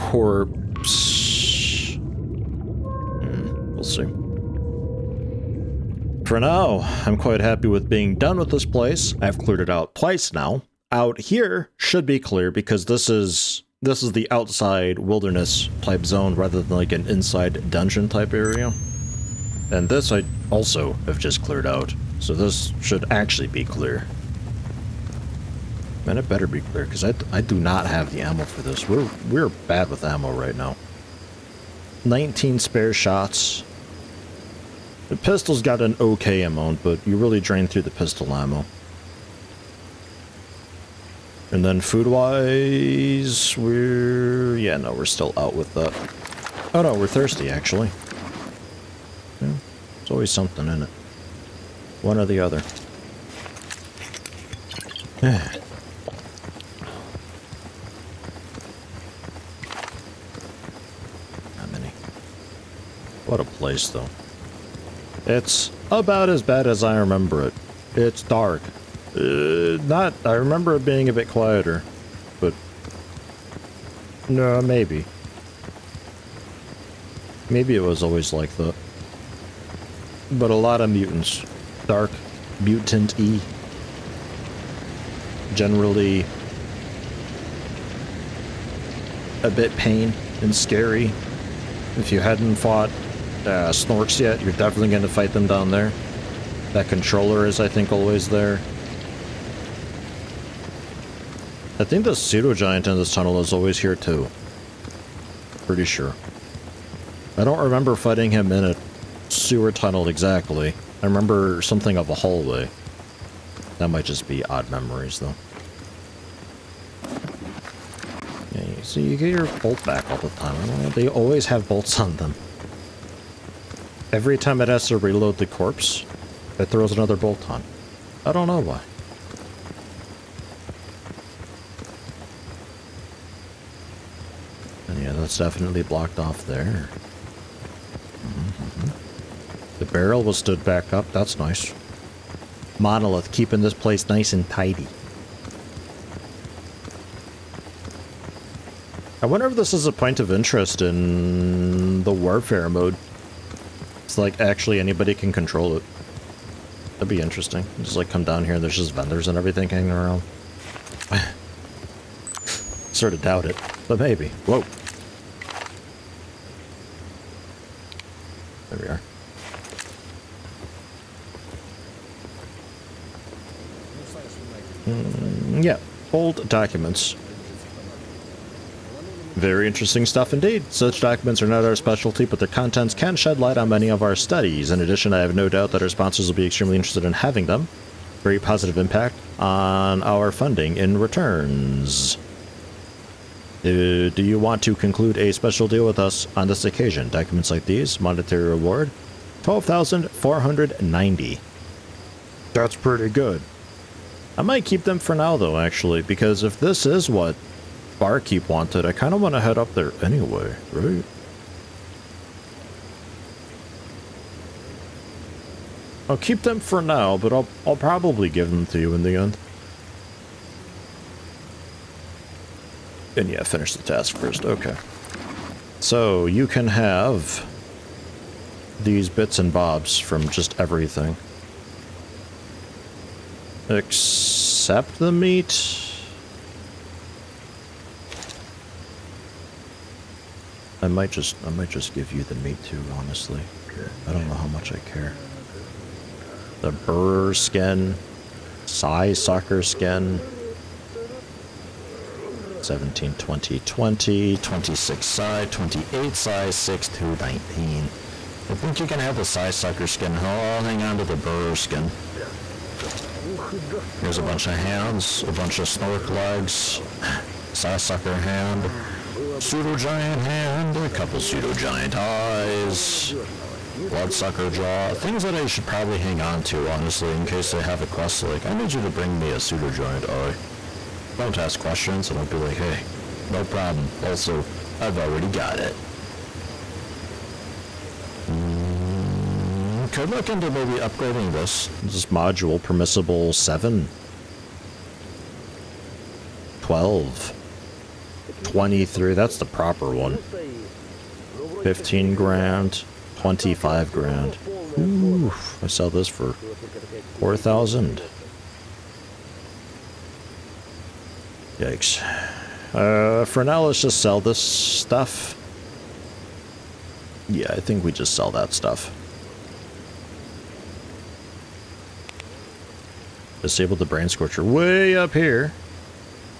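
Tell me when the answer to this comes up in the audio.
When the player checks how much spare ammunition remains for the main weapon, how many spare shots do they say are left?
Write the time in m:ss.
0:32.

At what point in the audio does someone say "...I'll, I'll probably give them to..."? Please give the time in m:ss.
3:37.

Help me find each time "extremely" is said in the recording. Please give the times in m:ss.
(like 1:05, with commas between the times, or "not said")
3:06.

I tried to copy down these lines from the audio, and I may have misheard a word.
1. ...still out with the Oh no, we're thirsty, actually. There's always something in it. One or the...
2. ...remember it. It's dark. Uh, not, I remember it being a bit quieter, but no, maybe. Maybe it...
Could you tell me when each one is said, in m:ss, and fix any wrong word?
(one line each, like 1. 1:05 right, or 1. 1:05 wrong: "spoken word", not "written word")
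1. 0:45 right
2. 1:06 right.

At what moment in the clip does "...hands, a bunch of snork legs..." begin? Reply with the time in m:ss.
4:24.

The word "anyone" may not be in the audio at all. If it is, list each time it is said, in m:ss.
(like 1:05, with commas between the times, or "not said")
not said.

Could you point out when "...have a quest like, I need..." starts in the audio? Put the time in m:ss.
4:37.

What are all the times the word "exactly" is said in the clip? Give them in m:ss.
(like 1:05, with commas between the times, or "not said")
1:50.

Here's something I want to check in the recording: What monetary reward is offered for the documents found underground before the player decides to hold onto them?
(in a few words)
12,490.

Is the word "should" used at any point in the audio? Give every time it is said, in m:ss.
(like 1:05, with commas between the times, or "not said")
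0:11, 0:22, 4:35.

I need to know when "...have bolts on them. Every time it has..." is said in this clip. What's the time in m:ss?
2:01.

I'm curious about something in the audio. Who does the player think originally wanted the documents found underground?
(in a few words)
Barkeep.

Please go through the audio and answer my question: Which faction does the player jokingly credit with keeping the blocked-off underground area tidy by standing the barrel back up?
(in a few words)
Monolith.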